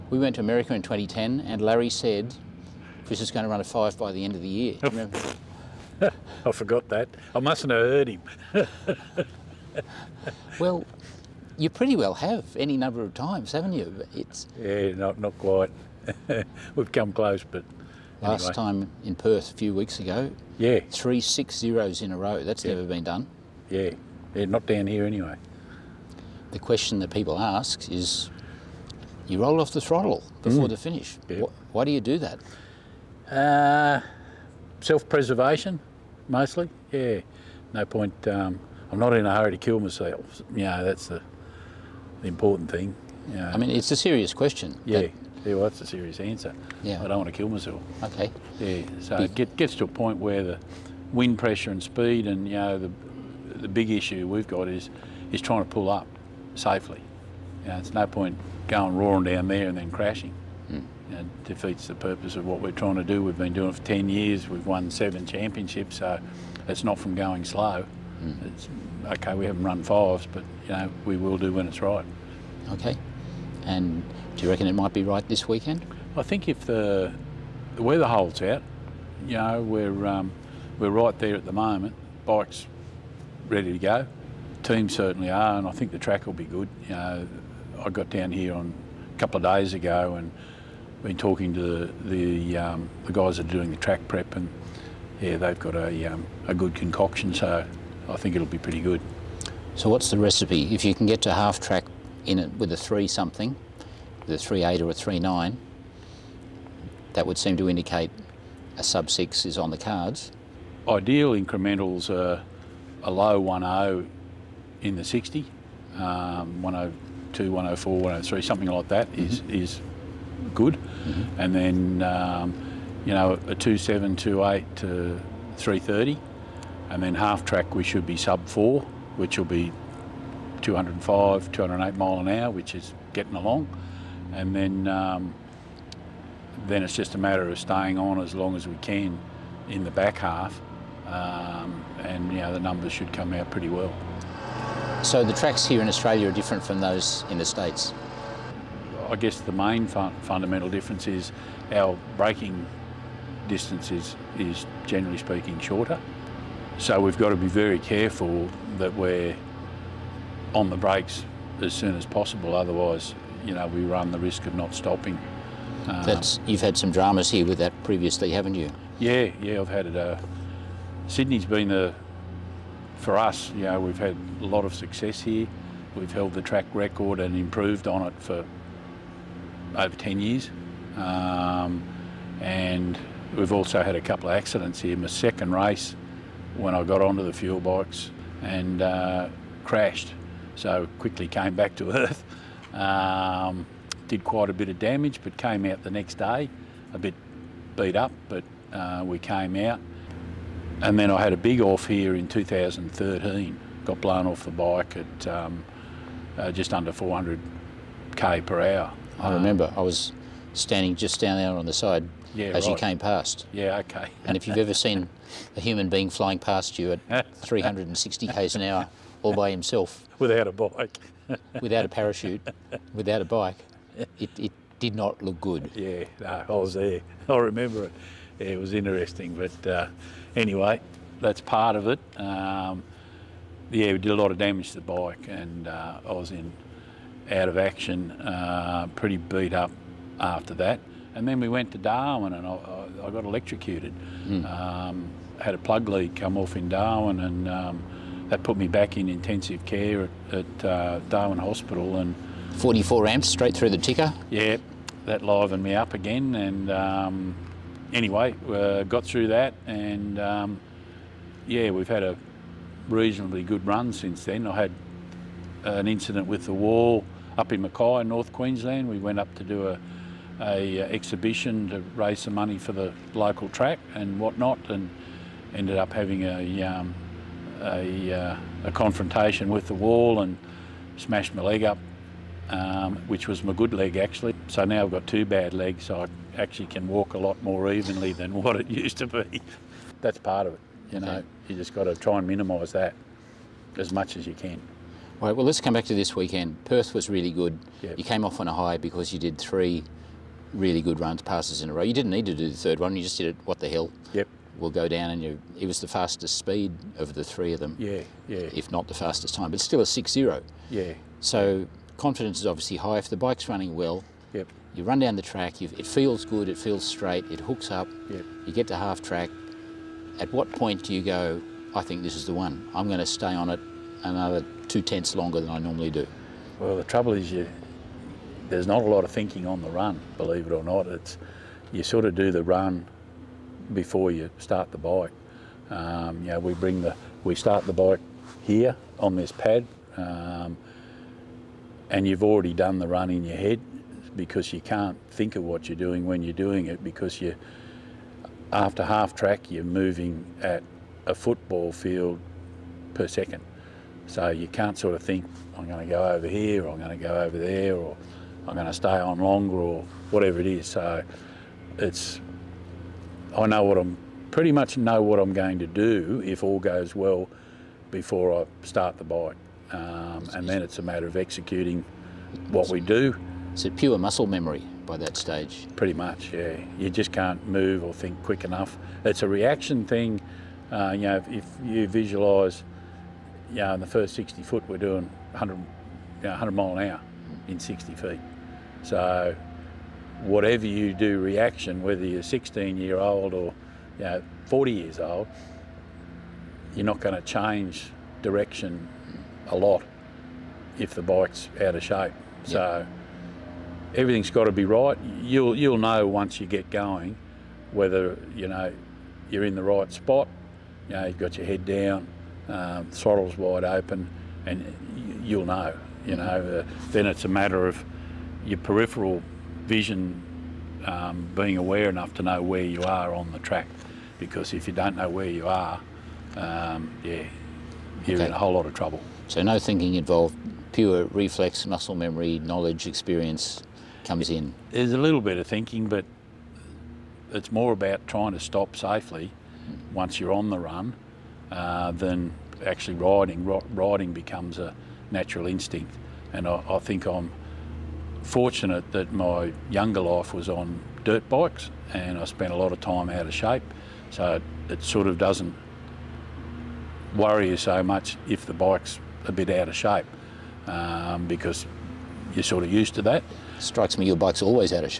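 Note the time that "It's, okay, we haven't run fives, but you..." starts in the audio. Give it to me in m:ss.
1:08.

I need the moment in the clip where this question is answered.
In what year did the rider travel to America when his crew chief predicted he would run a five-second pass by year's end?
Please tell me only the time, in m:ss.
0:00.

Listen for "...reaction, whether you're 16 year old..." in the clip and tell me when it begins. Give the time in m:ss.
6:31.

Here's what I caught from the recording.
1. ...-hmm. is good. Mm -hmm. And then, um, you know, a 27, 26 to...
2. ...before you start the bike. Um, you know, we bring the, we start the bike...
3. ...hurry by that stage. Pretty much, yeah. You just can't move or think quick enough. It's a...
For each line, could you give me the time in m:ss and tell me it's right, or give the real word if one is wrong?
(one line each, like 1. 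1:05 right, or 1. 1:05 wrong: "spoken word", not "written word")
1. 1:59 wrong: "28", not "26"
2. 5:33 right
3. 6:14 wrong: "memory", not "hurry".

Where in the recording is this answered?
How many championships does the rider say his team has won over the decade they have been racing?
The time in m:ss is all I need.
1:04.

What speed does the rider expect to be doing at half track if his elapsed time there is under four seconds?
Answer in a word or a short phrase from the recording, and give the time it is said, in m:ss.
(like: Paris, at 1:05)
205 to 208 mph, at 2:10.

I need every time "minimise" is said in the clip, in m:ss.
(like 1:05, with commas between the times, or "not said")
4:52.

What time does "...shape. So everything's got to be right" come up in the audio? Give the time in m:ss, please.
6:41.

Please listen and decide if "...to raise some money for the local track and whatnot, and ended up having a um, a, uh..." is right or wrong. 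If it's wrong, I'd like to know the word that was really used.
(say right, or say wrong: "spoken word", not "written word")
right.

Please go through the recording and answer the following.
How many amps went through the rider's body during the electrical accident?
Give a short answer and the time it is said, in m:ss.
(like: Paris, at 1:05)
44, at 4:12.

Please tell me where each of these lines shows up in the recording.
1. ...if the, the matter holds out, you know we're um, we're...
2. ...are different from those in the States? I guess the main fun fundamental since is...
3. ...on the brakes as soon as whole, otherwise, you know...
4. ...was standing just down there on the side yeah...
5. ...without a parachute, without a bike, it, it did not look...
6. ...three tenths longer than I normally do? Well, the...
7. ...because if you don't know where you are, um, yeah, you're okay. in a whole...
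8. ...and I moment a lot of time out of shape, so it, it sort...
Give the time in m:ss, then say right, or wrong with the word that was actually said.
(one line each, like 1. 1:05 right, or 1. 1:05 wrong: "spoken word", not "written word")
1. 1:16 wrong: "weather", not "matter"
2. 2:26 wrong: "difference", not "since"
3. 2:40 wrong: "possible", not "whole"
4. 3:29 right
5. 3:41 right
6. 5:24 wrong: "two", not "three"
7. 7:04 right
8. 7:31 wrong: "spent", not "moment".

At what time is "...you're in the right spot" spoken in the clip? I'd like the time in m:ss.
6:49.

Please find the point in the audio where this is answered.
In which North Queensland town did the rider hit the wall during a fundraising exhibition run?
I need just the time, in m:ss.
4:27.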